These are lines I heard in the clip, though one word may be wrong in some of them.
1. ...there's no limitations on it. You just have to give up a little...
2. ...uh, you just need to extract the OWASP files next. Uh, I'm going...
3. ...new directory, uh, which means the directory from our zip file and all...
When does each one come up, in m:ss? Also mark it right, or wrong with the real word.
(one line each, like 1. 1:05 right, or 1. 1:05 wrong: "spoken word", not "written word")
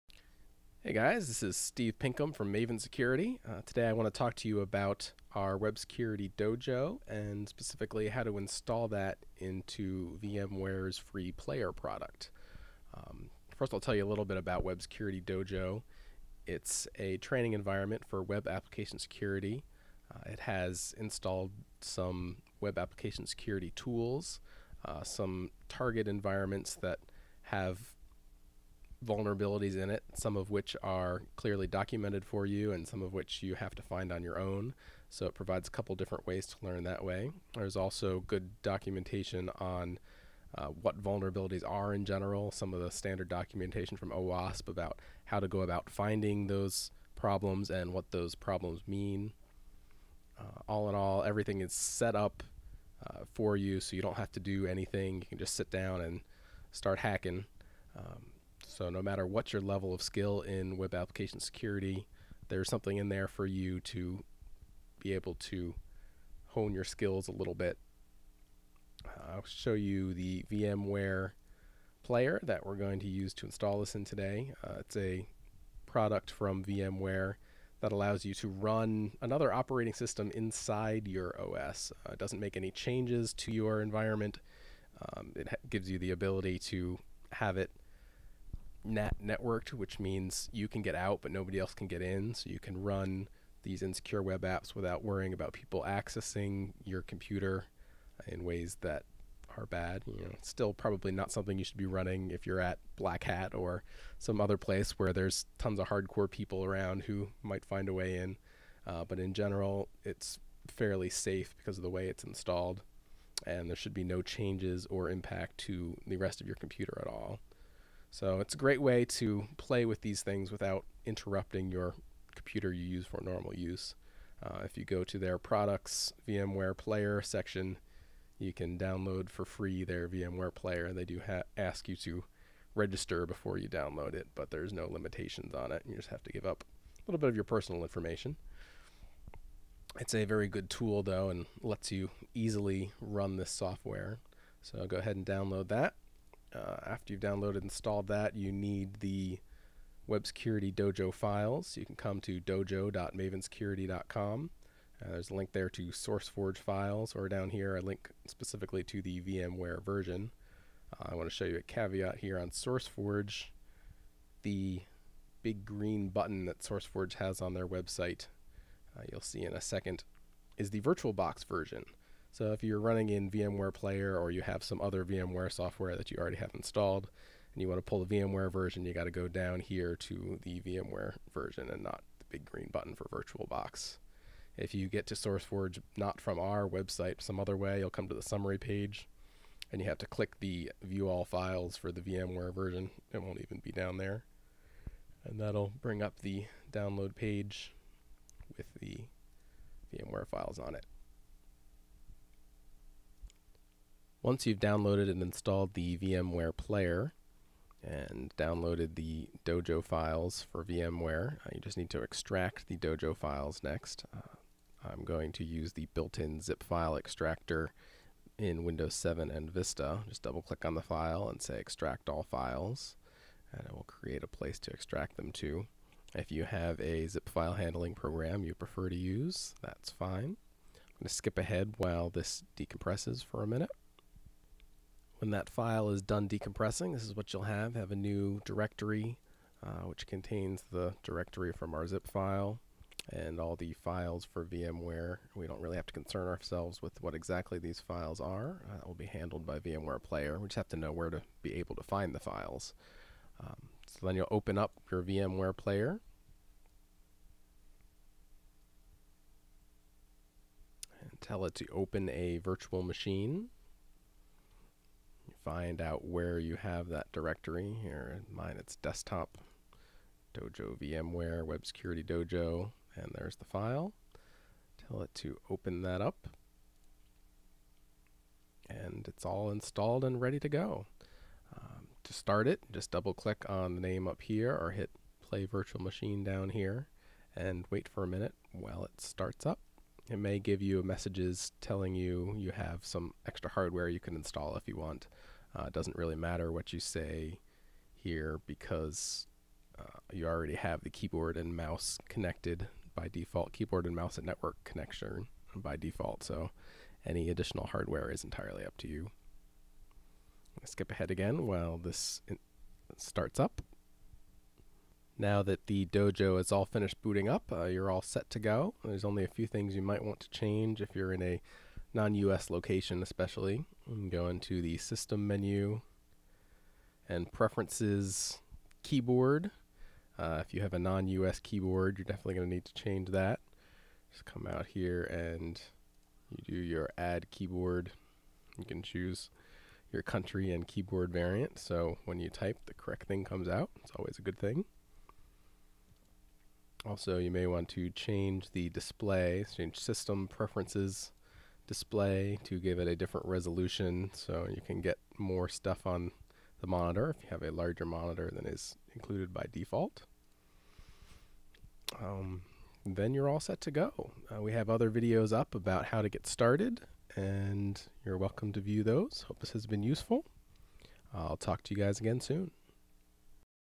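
1. 2:14 right
2. 3:31 wrong: "Dojo", not "OWASP"
3. 3:57 wrong: "contains", not "means".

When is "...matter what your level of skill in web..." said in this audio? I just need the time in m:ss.
0:59.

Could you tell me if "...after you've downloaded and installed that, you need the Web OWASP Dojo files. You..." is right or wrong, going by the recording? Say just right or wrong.
wrong.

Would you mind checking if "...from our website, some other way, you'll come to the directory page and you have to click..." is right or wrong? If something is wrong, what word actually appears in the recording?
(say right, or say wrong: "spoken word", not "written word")
wrong: "summary", not "directory".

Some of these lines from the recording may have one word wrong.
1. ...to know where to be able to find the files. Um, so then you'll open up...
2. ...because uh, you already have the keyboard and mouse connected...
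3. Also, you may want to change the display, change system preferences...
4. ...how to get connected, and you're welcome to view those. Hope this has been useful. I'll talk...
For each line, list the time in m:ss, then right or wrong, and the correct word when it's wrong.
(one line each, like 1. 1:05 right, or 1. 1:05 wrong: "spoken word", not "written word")
1. 4:10 right
2. 4:58 right
3. 5:46 right
4. 6:05 wrong: "started", not "connected".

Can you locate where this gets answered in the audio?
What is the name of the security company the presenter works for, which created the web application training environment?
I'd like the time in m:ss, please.
0:02.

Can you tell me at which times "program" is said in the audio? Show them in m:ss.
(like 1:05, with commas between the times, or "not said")
3:47.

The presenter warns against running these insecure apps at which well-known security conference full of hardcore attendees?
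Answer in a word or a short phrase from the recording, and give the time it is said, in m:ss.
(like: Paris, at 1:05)
Black Hat, at 1:42.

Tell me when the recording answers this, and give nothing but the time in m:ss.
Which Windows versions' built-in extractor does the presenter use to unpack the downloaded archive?
3:38.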